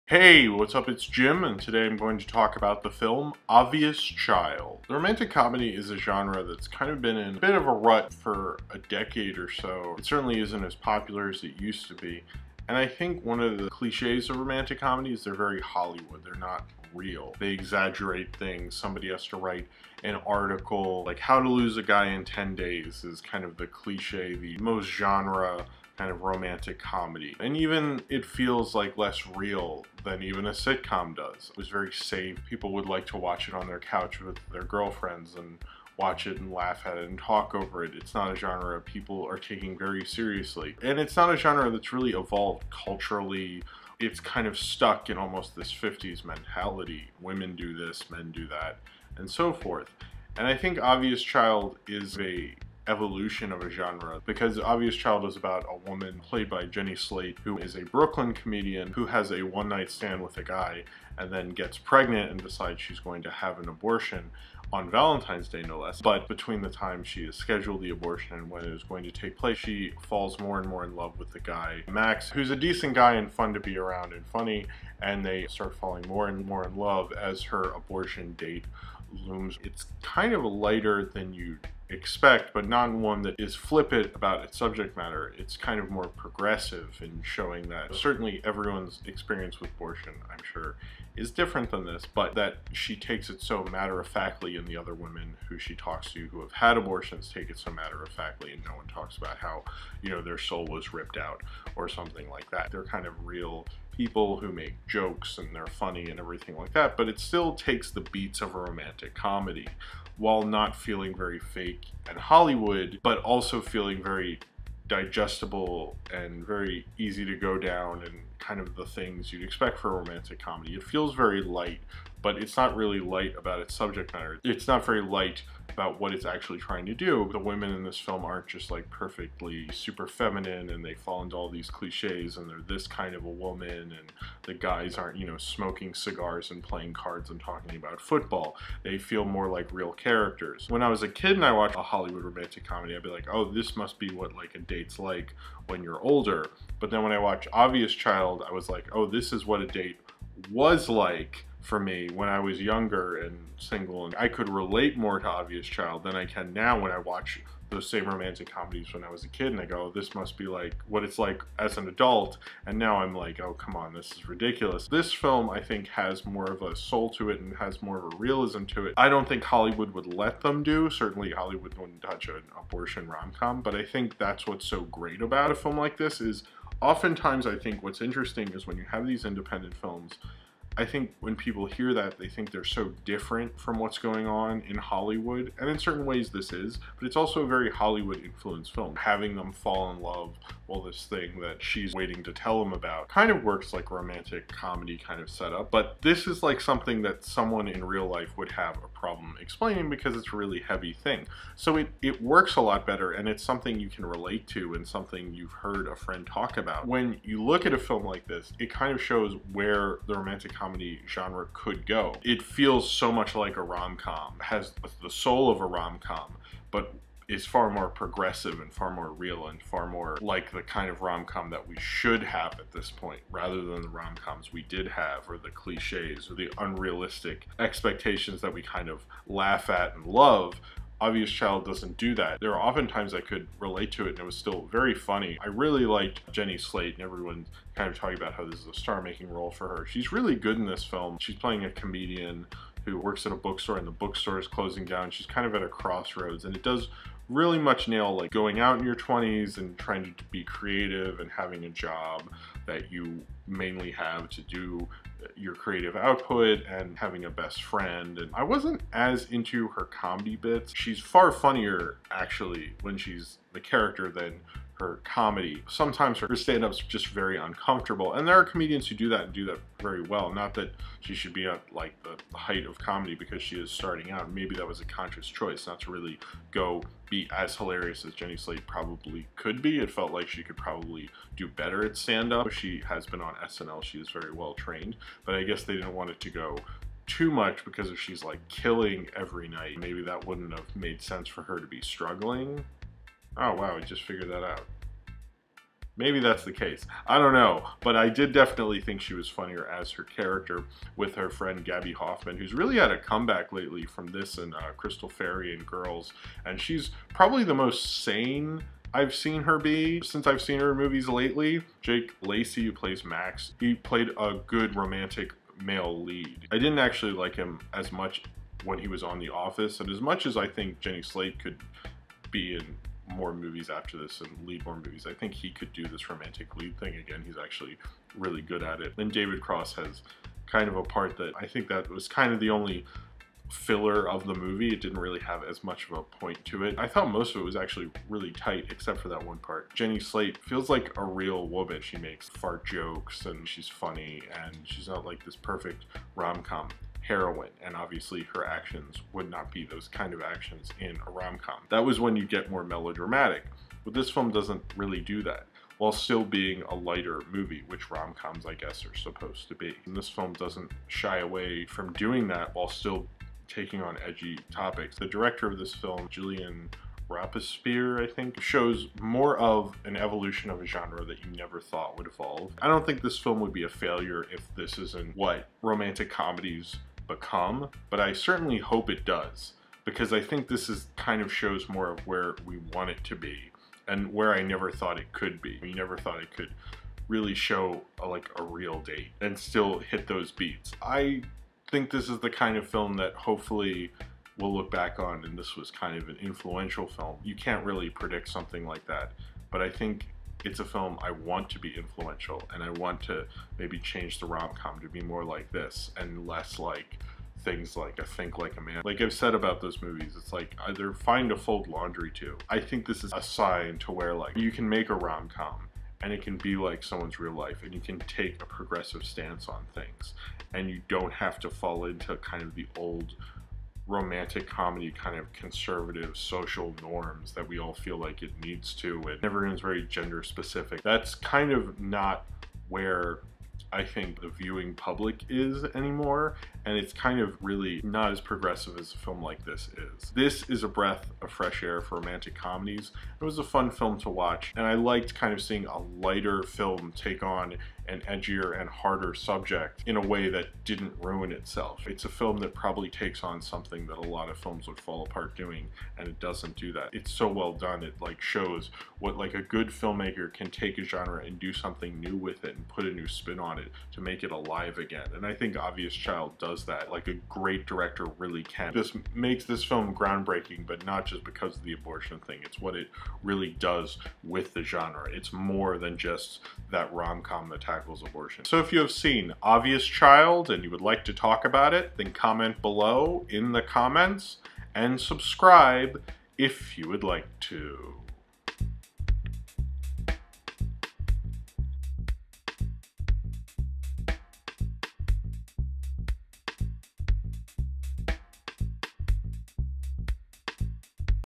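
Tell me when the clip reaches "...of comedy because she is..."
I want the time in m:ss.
4:32.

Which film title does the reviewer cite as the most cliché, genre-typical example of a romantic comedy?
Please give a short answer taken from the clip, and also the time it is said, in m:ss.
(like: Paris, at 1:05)
How to Lose a Guy in 10 Days, at 0:21.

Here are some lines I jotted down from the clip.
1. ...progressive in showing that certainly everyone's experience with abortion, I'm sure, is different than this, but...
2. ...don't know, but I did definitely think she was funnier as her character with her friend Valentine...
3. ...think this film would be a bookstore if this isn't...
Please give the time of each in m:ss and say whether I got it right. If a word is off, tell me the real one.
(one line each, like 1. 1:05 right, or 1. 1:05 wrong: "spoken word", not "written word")
1. 1:26 right
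2. 4:57 wrong: "Gaby", not "Valentine"
3. 6:12 wrong: "failure", not "bookstore".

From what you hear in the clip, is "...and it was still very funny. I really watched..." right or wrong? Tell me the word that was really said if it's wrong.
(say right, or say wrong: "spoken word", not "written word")
wrong: "liked", not "watched".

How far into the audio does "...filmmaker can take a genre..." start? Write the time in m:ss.
7:39.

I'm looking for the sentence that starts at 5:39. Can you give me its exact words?
Jenny Slate feels like a real woman.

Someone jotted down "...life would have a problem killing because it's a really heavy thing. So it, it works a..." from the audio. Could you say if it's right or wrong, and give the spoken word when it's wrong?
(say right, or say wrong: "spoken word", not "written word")
wrong: "explaining", not "killing".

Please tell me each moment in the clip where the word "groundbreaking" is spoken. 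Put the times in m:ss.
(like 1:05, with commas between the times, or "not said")
7:49.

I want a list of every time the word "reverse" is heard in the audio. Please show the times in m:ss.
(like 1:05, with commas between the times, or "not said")
not said.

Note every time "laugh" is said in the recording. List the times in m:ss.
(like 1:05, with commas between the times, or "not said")
0:36, 3:49.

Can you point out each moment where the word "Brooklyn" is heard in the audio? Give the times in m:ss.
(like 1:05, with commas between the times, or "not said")
0:57.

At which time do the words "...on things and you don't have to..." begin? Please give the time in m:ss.
6:59.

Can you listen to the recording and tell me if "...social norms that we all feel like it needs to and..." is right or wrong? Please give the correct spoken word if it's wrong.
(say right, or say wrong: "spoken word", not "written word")
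right.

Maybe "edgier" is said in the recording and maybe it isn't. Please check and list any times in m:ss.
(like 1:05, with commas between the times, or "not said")
7:28.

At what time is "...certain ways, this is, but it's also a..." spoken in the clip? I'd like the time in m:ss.
3:05.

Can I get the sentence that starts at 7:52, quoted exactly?
It's what it really does with the genre.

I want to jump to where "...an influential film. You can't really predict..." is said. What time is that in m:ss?
6:36.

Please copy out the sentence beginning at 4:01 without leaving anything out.
She's playing a comedian who works at a bookstore and the bookstore is closing down.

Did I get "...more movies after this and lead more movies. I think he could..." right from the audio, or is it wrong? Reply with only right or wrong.
right.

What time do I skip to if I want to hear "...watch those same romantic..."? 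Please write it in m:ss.
2:36.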